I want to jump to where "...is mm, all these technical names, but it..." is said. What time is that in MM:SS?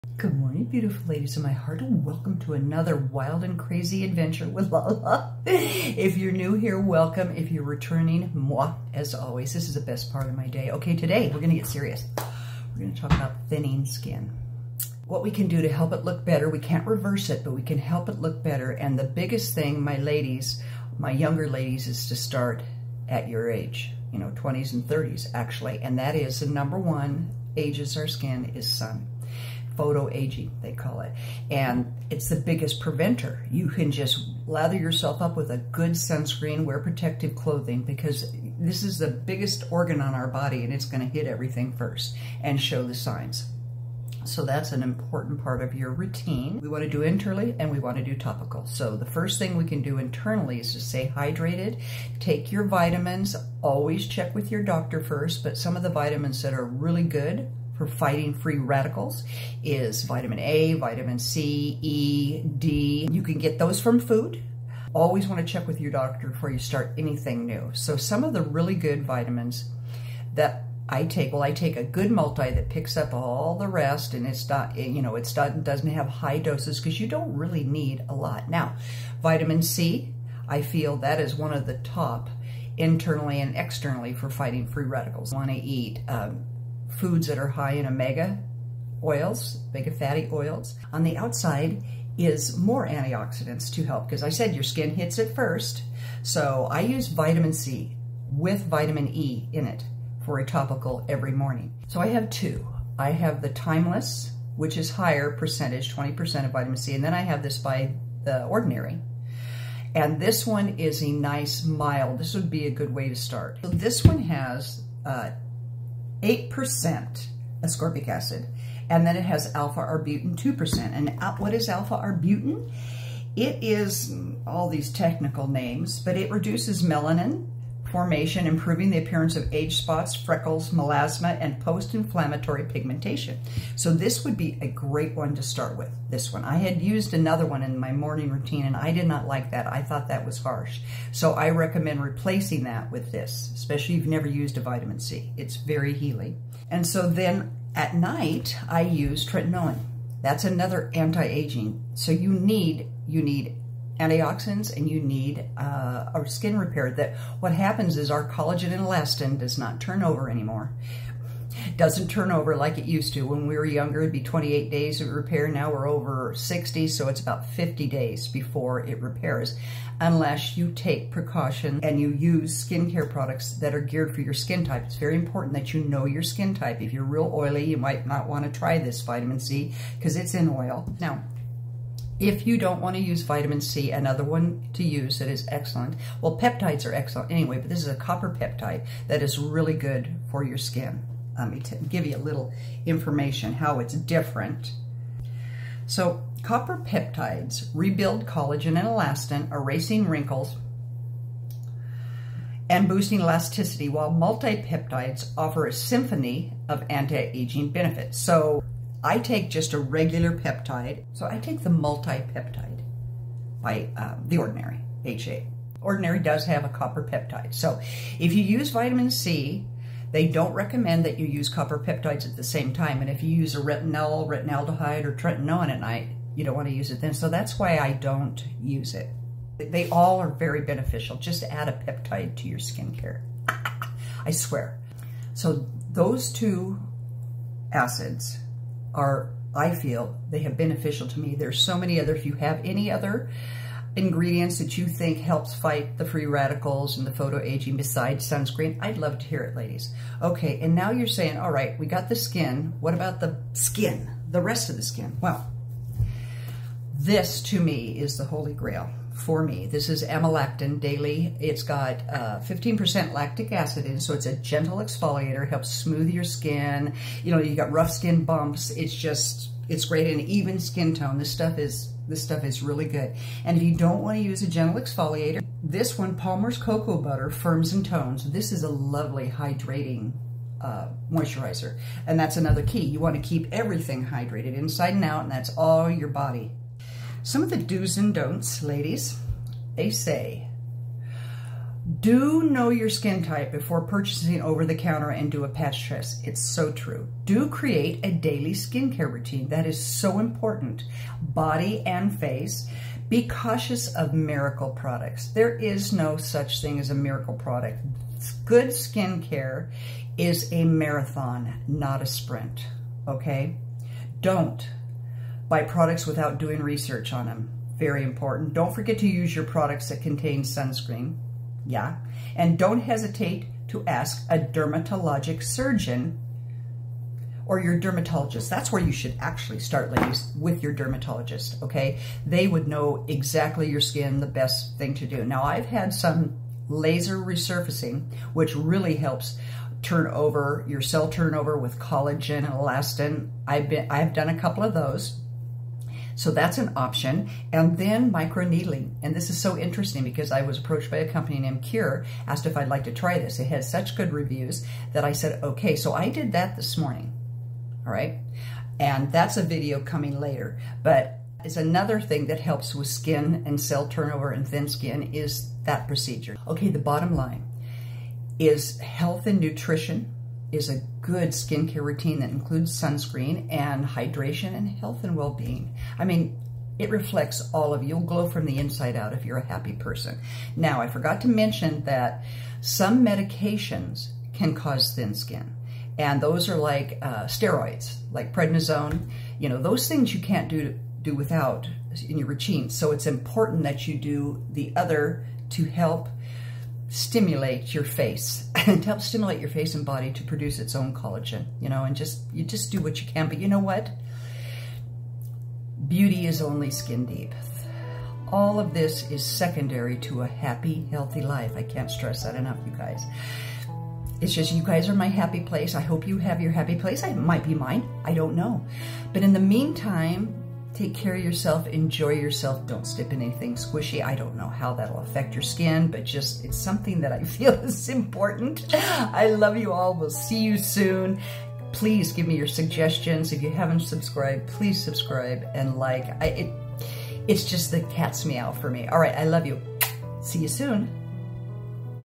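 02:03.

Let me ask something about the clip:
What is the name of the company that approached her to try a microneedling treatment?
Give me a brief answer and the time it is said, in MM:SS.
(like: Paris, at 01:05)
Cure, at 05:51.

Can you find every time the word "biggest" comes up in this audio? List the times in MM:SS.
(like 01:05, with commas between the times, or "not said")
00:19, 00:32, 00:39.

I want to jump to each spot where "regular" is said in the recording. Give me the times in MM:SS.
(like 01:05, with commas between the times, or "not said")
03:29.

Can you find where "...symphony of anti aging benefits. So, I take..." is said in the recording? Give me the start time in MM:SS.
03:25.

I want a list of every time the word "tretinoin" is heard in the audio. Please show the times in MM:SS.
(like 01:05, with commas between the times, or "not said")
02:29, 03:45.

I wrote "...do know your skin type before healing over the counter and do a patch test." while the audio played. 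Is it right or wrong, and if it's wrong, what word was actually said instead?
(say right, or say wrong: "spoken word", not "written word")
wrong: "purchasing", not "healing".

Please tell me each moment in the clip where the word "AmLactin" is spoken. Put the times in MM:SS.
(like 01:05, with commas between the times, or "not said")
04:20.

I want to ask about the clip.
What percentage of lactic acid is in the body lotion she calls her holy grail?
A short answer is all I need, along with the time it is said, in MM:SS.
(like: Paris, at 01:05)
15%, at 04:22.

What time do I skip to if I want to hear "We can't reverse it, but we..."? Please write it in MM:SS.
00:16.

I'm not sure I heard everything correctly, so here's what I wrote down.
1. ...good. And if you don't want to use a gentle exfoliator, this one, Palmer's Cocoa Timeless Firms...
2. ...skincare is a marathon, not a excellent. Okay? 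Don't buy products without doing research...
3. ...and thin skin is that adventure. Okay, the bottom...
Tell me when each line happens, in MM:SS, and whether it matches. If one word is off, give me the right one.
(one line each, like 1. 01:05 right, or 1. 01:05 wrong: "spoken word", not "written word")
1. 04:32 wrong: "Butter", not "Timeless"
2. 05:08 wrong: "sprint", not "excellent"
3. 06:04 wrong: "procedure", not "adventure".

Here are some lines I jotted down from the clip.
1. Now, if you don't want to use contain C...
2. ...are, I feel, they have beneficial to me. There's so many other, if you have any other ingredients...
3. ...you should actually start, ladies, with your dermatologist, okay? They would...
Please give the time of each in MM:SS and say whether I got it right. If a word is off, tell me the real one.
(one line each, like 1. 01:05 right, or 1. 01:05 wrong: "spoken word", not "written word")
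1. 03:00 wrong: "vitamin", not "contain"
2. 03:58 right
3. 05:28 right.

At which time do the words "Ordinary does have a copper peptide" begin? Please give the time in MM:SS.
03:35.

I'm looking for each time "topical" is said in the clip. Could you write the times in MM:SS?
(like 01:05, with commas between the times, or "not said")
00:48, 01:40.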